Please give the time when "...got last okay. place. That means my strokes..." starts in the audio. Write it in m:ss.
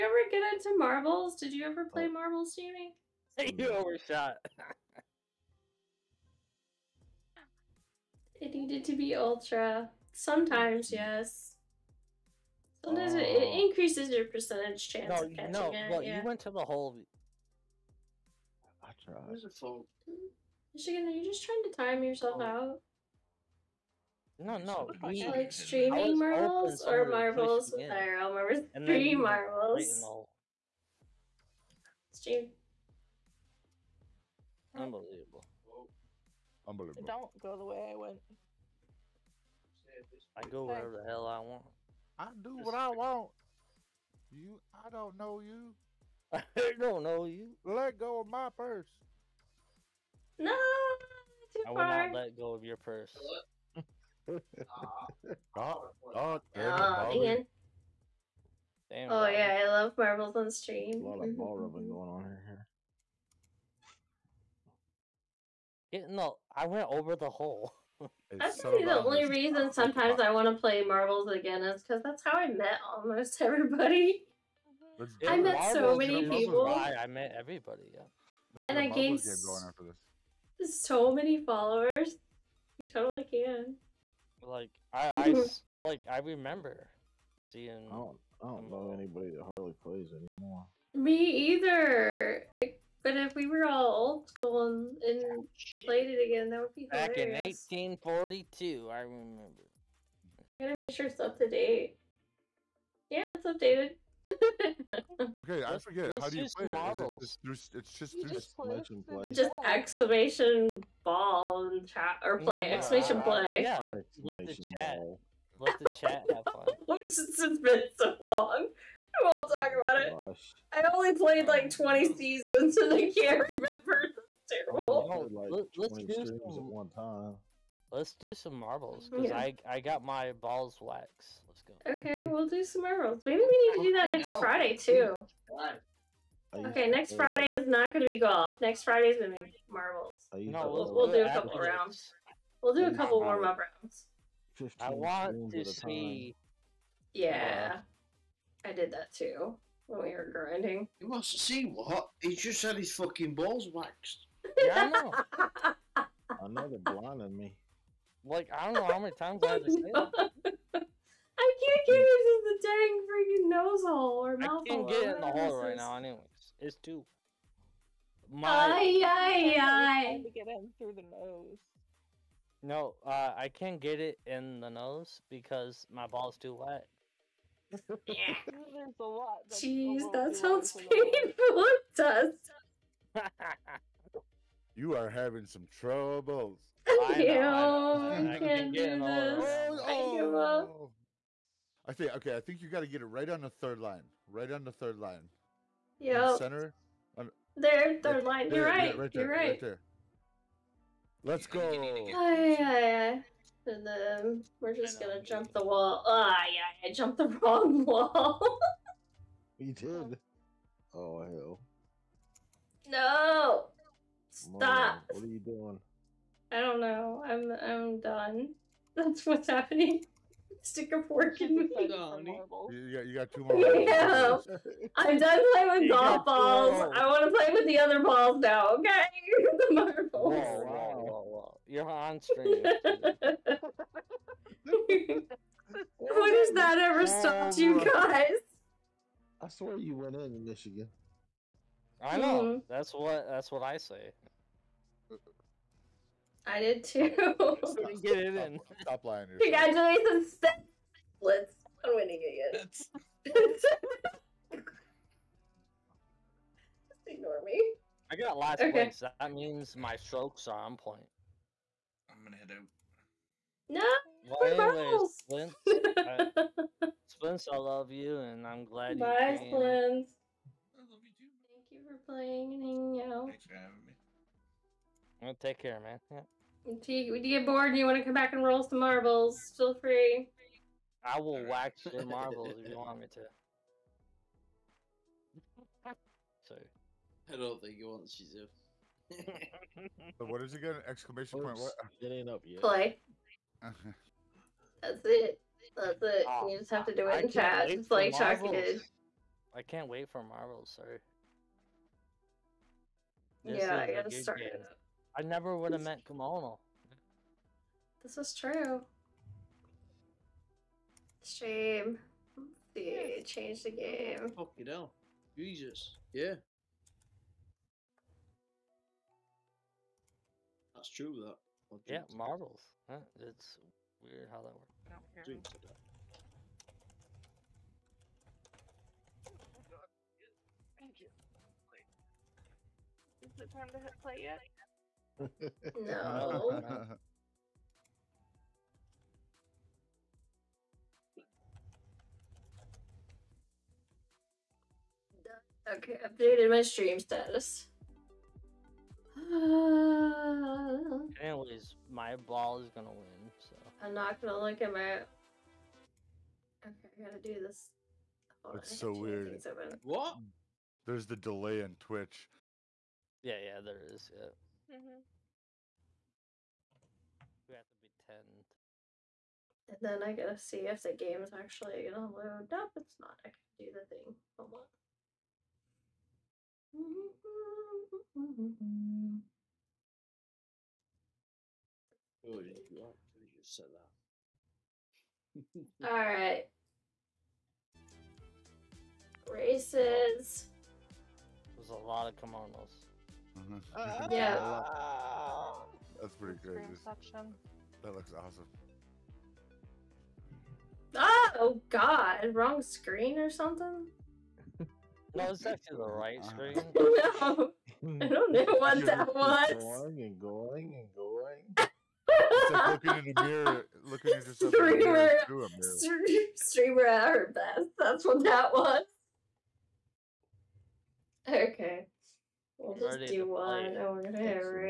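4:18.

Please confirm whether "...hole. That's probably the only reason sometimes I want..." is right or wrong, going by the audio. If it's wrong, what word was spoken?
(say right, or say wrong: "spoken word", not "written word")
right.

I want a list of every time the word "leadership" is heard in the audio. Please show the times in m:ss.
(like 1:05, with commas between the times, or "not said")
not said.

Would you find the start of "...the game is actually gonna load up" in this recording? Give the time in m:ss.
6:10.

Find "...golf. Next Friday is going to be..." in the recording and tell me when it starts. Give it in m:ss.
2:18.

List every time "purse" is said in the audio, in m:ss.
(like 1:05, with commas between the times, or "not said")
0:48, 0:52.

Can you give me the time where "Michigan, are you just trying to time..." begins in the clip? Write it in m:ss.
0:20.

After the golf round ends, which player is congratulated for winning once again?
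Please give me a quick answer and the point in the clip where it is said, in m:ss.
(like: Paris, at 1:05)
Blitz, at 4:11.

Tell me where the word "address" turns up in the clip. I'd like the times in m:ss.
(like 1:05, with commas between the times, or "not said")
not said.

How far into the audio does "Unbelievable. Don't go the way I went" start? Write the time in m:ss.
0:36.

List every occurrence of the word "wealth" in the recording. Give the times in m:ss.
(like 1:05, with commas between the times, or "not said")
not said.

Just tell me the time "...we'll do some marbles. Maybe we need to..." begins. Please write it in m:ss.
2:12.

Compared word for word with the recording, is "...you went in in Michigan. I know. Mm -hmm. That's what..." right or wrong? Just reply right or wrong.
right.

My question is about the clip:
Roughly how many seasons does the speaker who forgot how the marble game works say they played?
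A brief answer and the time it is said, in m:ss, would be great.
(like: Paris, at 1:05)
20, at 2:01.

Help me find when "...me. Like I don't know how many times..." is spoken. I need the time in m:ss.
2:37.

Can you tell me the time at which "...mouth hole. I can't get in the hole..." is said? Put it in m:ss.
2:44.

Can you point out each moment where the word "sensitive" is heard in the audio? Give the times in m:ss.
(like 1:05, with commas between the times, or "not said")
not said.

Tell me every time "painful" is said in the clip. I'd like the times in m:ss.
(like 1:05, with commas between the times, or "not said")
3:00.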